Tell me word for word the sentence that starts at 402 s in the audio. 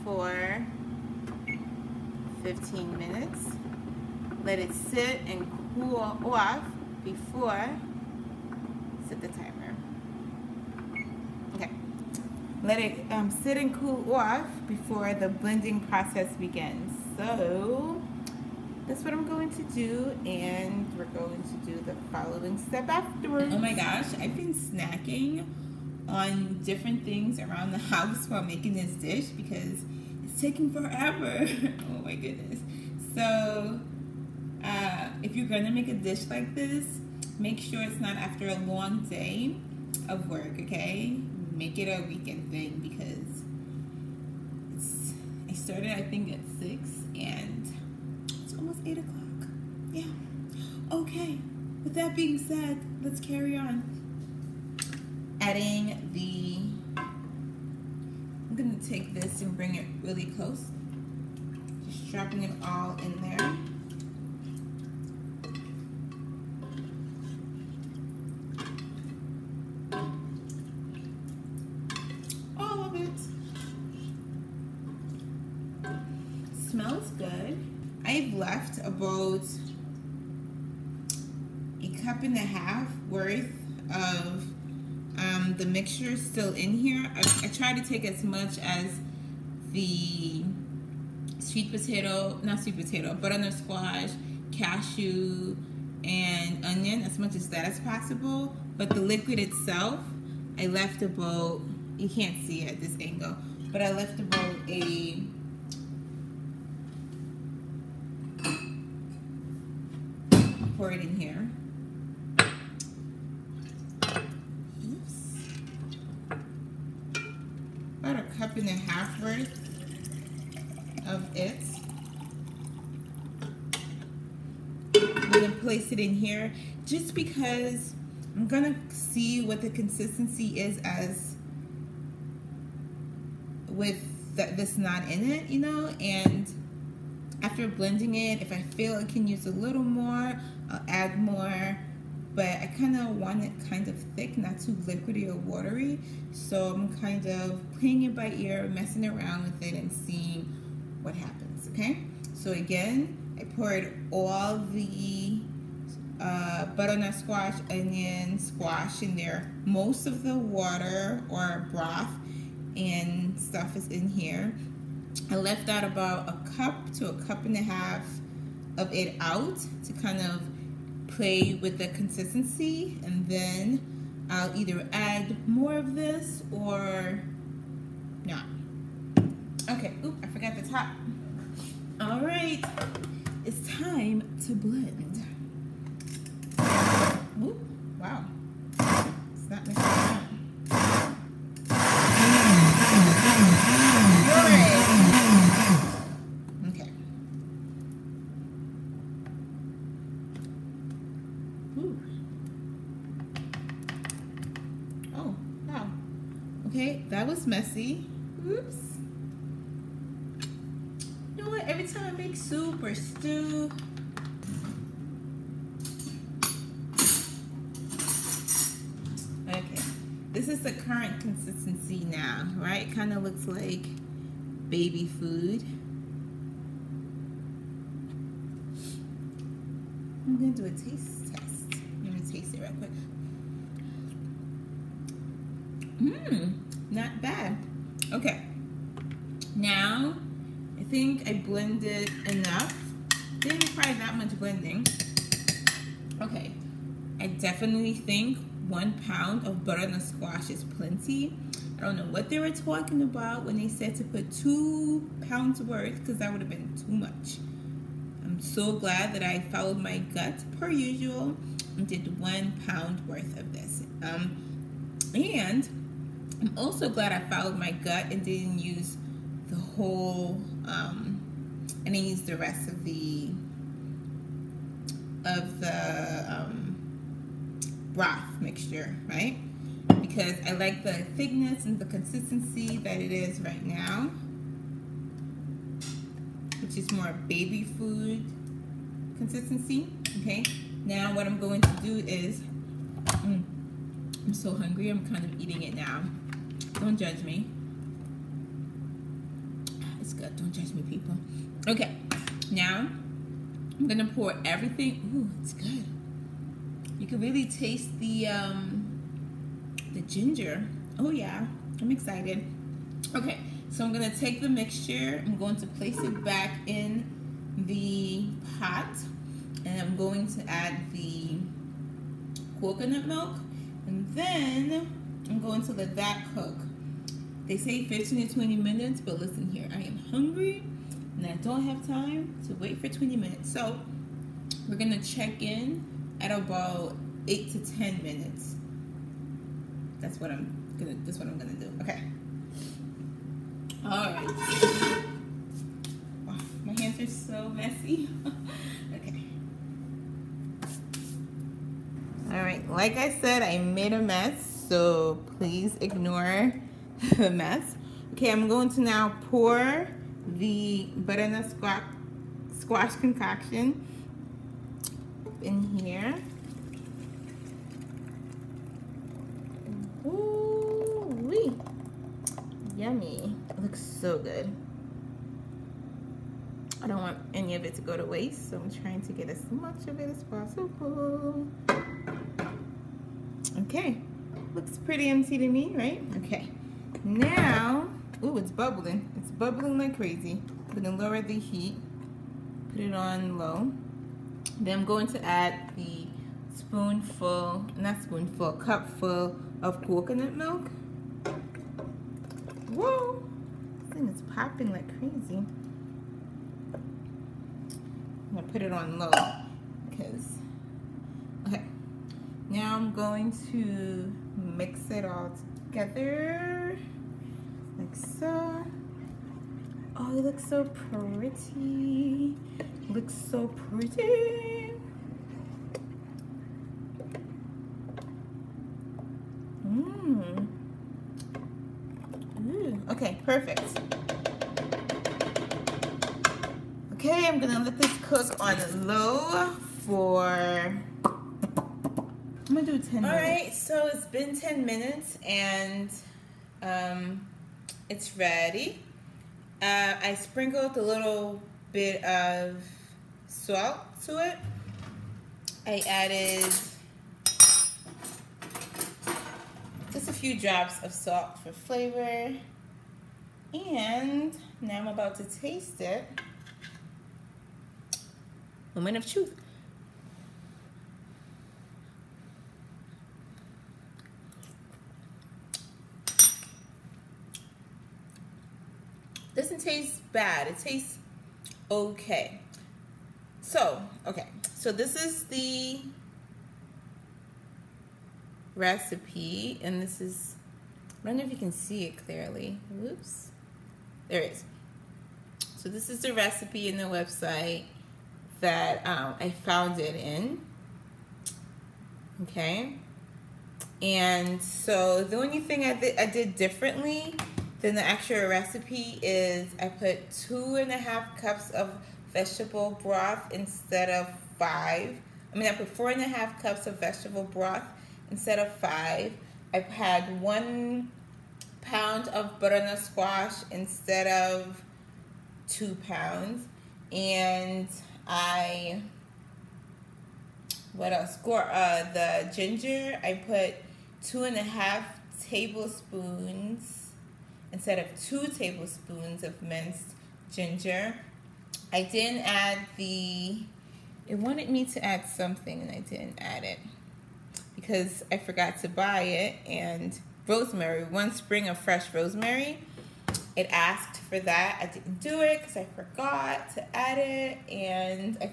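Whoa, this thing is popping like crazy.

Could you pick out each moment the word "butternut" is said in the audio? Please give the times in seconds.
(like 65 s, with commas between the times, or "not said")
93 s, 156 s, 249 s, 360 s, 522 s.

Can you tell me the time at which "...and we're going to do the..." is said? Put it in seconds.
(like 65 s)
20 s.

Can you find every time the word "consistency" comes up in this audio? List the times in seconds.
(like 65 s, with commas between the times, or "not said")
129 s, 171 s, 221 s, 281 s, 289 s.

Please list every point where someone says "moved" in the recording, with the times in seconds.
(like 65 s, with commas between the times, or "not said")
not said.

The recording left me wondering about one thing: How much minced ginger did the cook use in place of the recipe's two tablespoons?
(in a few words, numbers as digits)
2 and a half tablespoons.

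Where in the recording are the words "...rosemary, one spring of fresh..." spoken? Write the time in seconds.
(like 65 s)
550 s.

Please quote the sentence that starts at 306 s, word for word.
You can really taste the um, the ginger.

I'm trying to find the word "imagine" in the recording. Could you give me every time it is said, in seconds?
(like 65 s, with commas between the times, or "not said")
not said.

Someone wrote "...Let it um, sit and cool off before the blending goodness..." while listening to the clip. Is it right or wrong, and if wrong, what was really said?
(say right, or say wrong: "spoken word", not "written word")
wrong: "process", not "goodness".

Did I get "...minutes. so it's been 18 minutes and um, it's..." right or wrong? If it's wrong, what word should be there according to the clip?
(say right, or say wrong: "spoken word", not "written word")
wrong: "10", not "18".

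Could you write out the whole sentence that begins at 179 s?
Okay, oop, I forgot the top.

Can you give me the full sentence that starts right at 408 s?
I'm gonna put it on low because, okay.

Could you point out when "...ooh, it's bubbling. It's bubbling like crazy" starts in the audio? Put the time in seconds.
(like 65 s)
388 s.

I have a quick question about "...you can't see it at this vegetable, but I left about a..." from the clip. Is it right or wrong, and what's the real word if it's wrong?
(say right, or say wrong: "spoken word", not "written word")
wrong: "angle", not "vegetable".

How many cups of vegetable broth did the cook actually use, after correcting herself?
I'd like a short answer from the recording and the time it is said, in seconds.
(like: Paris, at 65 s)
4 and a half cups, at 515 s.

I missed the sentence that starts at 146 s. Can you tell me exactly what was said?
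So I'm kind of playing it by ear, messing around with it and seeing what happens, okay?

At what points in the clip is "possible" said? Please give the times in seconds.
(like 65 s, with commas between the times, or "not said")
97 s, 380 s.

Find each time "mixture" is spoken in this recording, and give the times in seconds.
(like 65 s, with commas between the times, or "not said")
85 s, 278 s, 314 s.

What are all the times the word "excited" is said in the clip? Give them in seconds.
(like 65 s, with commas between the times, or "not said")
311 s.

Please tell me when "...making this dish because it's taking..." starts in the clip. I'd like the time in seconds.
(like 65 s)
28 s.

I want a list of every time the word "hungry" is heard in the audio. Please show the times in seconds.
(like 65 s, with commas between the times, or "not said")
294 s, 330 s.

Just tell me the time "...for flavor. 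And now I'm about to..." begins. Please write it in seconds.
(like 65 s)
461 s.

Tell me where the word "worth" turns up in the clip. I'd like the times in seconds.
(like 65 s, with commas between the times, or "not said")
83 s, 119 s, 255 s, 263 s.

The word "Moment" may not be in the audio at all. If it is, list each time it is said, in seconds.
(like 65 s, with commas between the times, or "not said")
468 s.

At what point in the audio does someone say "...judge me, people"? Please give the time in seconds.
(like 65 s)
300 s.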